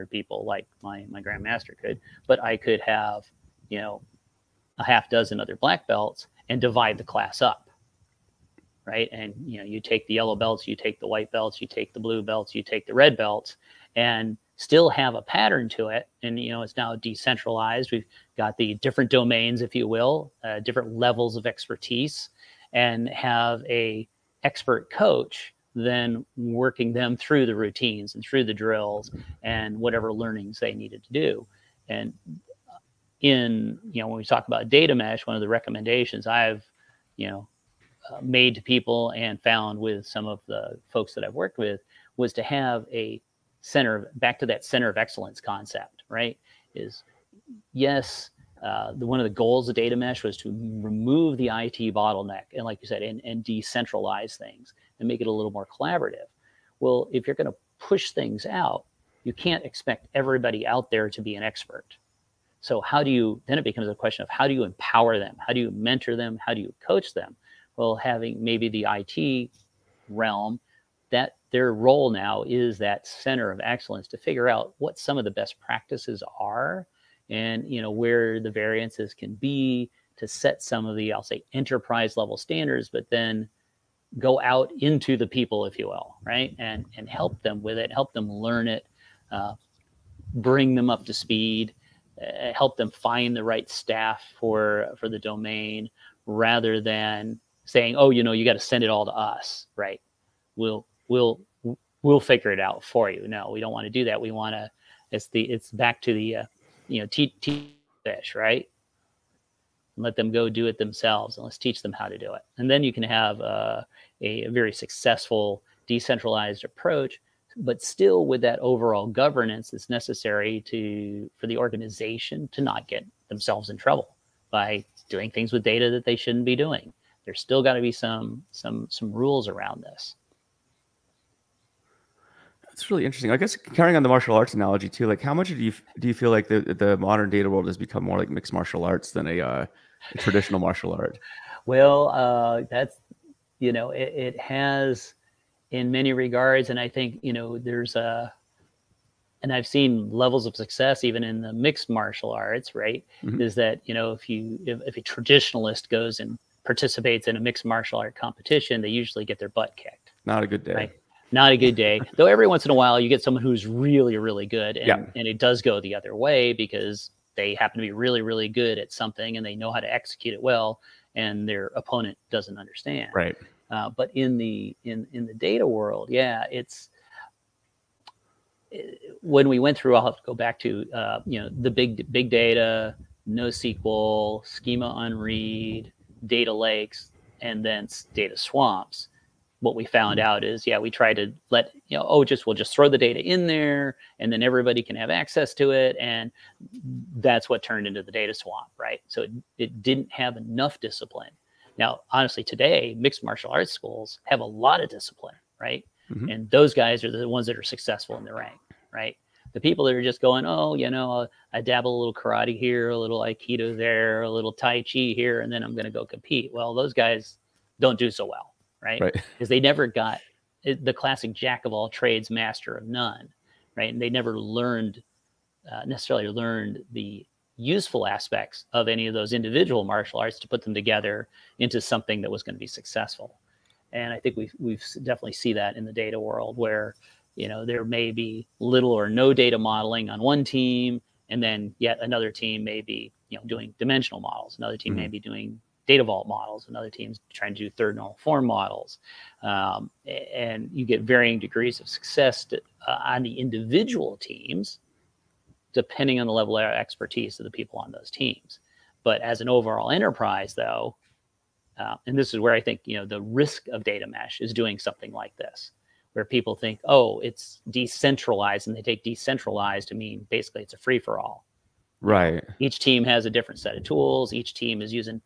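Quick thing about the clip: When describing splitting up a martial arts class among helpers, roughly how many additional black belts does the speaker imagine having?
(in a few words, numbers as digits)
a half dozen.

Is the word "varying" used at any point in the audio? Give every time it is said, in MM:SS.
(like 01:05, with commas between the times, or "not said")
04:11.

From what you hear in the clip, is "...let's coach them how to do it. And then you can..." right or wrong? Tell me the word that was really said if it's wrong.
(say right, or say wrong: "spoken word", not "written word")
wrong: "teach", not "coach".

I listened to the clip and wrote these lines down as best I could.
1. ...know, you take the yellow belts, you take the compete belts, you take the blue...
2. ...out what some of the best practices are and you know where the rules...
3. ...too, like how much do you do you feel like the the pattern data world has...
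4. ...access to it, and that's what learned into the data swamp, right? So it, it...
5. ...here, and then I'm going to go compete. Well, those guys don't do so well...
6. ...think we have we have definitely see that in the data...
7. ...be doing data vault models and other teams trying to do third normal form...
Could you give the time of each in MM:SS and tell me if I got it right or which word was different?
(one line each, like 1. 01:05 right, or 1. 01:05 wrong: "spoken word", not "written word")
1. 00:09 wrong: "white", not "compete"
2. 01:14 wrong: "variances", not "rules"
3. 02:14 wrong: "modern", not "pattern"
4. 03:15 wrong: "turned", not "learned"
5. 03:35 right
6. 03:54 right
7. 04:05 right.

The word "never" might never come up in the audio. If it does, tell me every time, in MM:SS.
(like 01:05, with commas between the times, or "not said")
03:39, 03:44.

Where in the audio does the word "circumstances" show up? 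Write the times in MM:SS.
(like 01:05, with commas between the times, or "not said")
not said.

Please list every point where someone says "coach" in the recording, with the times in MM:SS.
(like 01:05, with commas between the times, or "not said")
00:24, 01:06.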